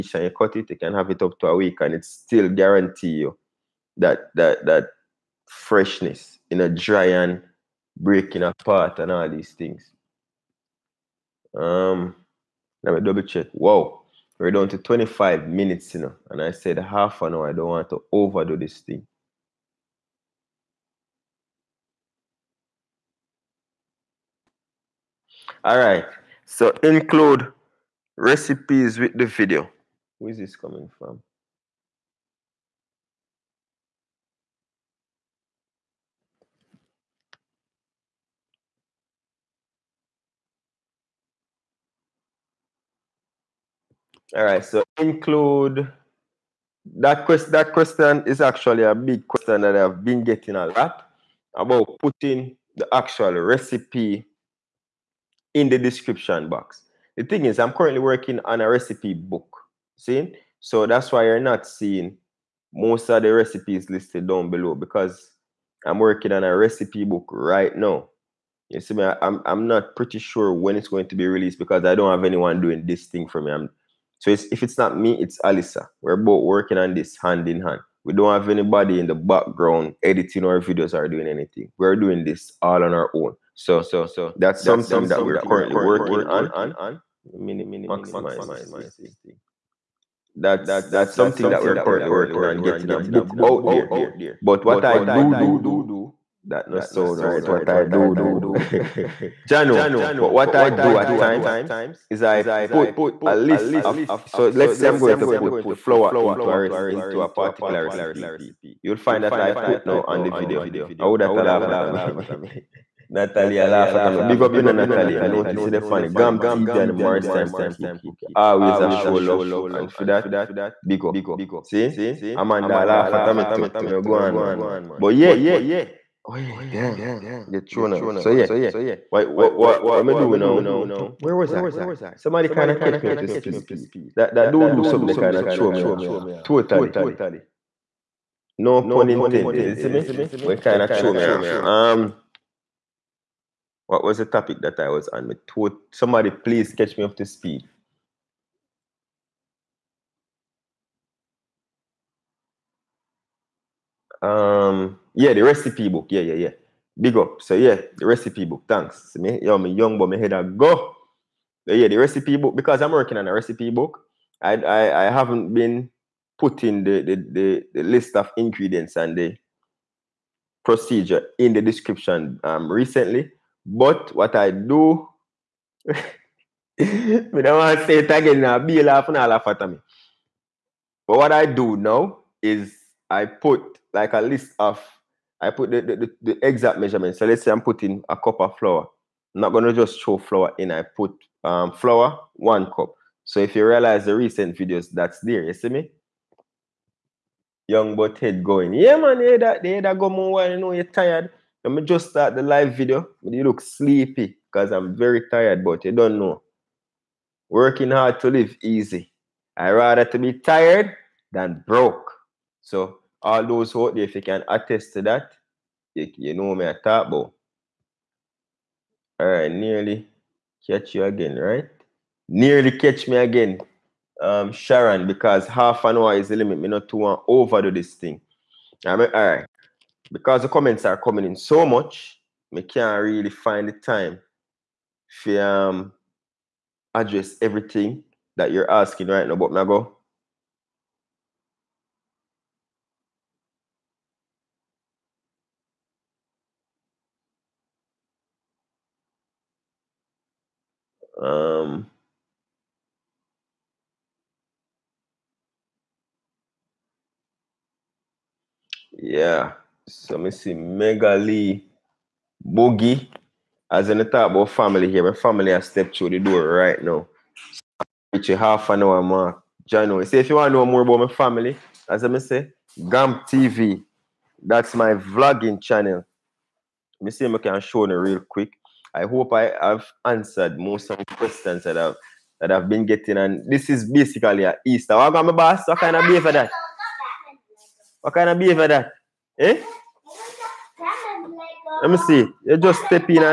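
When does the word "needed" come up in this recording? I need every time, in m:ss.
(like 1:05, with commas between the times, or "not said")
not said.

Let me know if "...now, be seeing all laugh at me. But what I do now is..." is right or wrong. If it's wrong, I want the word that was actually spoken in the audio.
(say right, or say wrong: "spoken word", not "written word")
wrong: "laughing", not "seeing".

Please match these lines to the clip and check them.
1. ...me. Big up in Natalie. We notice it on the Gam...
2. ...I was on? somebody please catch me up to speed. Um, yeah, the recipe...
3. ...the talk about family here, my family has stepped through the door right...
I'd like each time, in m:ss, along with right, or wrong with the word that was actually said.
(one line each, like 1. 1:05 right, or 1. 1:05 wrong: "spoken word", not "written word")
1. 1:54 right
2. 2:24 right
3. 4:23 right.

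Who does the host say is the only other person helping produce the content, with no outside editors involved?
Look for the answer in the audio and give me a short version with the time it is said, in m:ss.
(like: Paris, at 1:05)
Alisa, at 1:15.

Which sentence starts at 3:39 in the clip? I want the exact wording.
All right, nearly Catch you again, right?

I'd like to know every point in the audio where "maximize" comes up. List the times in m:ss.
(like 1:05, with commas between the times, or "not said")
1:27.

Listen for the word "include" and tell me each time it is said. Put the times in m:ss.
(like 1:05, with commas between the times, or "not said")
0:26, 0:44.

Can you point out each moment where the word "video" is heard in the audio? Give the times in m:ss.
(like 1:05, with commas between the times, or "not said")
0:29, 1:20, 1:50, 3:14, 3:22.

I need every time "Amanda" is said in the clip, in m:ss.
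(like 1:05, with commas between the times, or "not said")
2:02.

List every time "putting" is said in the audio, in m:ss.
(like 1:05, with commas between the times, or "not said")
0:51, 2:46, 3:07.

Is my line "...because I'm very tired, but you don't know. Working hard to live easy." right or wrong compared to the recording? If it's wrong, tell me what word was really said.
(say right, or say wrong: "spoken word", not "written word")
right.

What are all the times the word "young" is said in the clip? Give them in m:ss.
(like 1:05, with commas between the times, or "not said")
2:39, 3:17.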